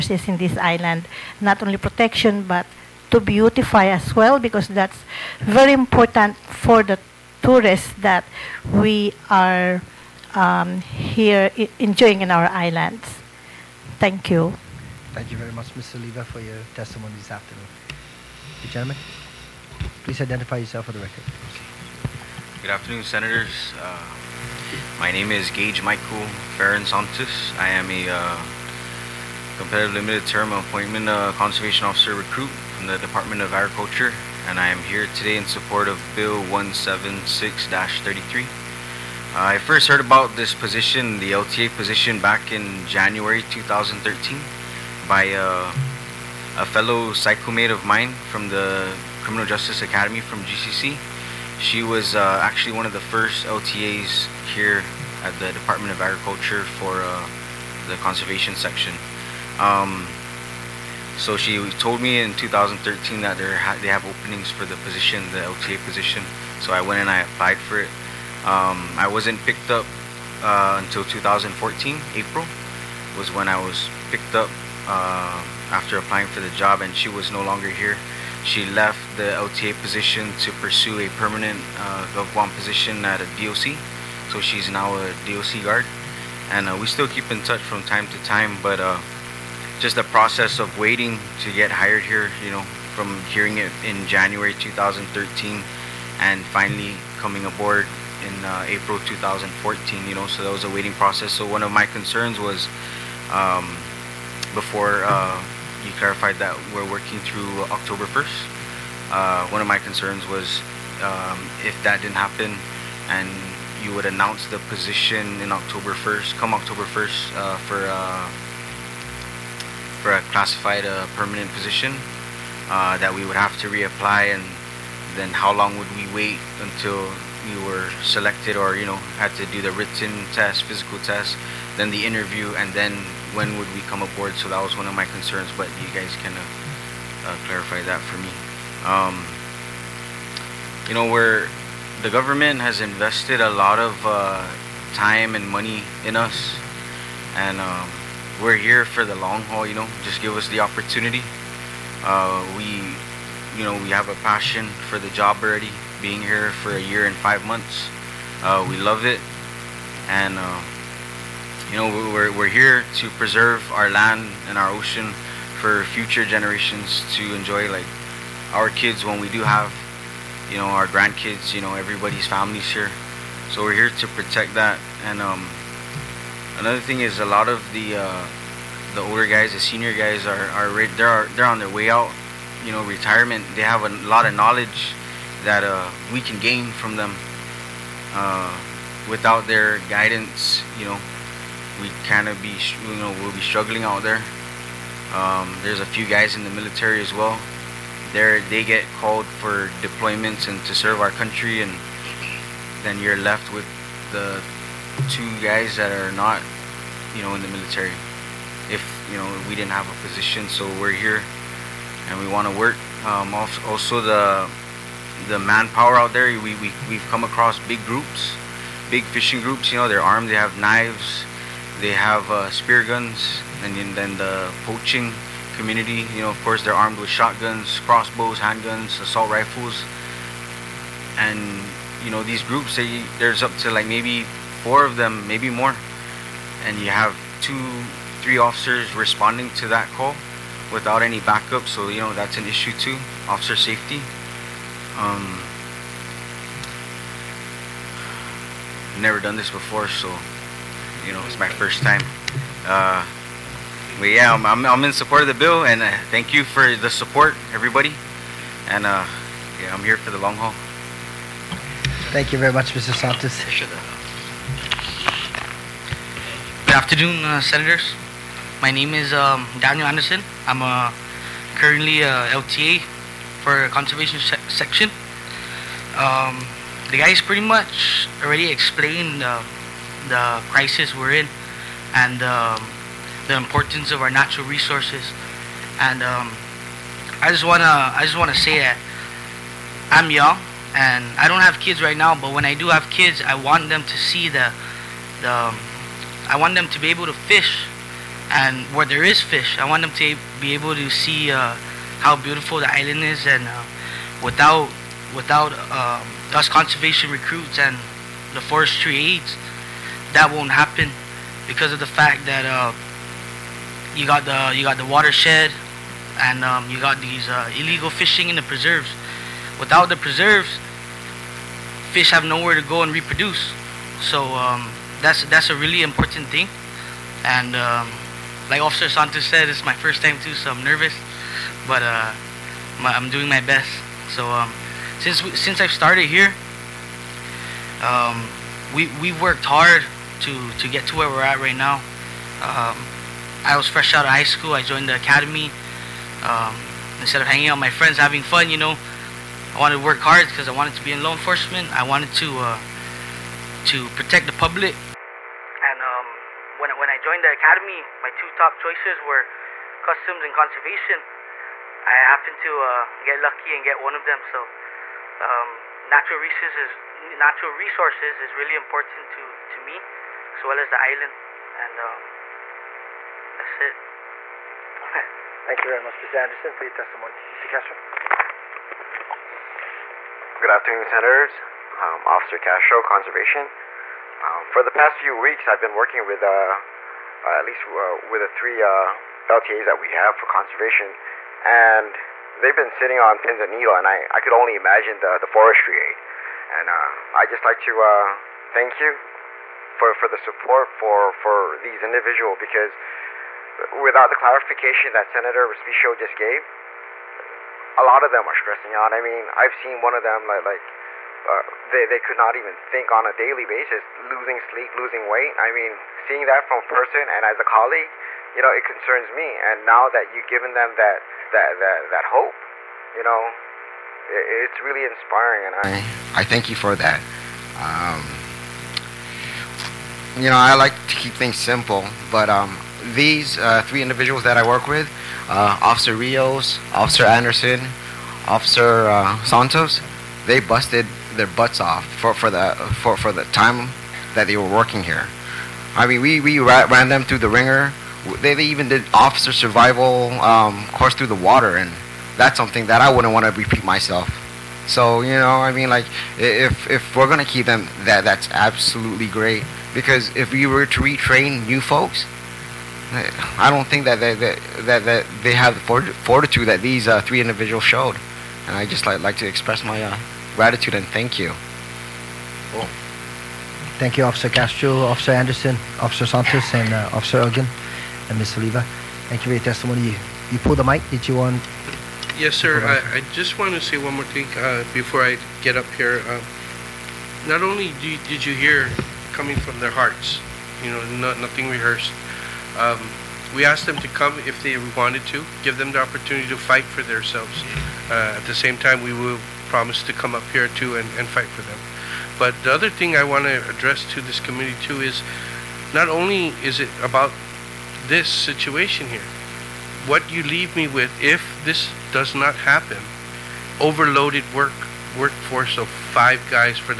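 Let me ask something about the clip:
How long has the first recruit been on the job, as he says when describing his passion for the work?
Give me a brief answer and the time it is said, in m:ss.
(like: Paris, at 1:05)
a year and five months, at 2:36.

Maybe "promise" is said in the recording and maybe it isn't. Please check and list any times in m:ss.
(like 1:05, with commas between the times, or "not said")
8:19.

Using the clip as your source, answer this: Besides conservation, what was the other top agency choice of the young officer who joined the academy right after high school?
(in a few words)
customs.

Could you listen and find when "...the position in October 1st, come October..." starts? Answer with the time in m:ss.
1:54.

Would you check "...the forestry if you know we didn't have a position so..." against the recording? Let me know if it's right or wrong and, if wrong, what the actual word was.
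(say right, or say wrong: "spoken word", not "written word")
wrong: "military", not "forestry".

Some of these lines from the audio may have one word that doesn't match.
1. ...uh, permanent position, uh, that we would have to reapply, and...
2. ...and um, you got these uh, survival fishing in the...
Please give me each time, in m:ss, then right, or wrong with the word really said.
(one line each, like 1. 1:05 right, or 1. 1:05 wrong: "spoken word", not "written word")
1. 2:00 right
2. 5:16 wrong: "illegal", not "survival".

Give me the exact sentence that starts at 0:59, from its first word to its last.
Um, so she told me in 2013 that ha they have openings for the position, the OTA position.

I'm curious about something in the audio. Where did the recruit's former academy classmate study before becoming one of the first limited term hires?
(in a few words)
GCC.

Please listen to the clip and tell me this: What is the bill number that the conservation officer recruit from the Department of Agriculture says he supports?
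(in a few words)
176-33.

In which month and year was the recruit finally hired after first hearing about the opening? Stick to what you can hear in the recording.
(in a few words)
April 2014.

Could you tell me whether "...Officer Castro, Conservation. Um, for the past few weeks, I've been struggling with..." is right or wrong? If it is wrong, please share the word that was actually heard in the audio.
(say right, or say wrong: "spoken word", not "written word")
wrong: "working", not "struggling".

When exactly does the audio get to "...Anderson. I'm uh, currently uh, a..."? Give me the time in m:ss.
4:29.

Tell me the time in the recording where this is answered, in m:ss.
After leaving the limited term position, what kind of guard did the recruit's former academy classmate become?
1:25.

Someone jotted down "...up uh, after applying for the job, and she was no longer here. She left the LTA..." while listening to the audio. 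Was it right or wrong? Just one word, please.
right.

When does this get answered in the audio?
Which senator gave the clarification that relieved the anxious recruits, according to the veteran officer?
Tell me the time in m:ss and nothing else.
6:45.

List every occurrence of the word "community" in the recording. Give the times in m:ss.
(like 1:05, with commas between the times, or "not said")
3:45, 8:24.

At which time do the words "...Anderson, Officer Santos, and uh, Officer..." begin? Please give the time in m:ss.
7:55.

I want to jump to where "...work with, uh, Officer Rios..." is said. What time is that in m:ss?
7:14.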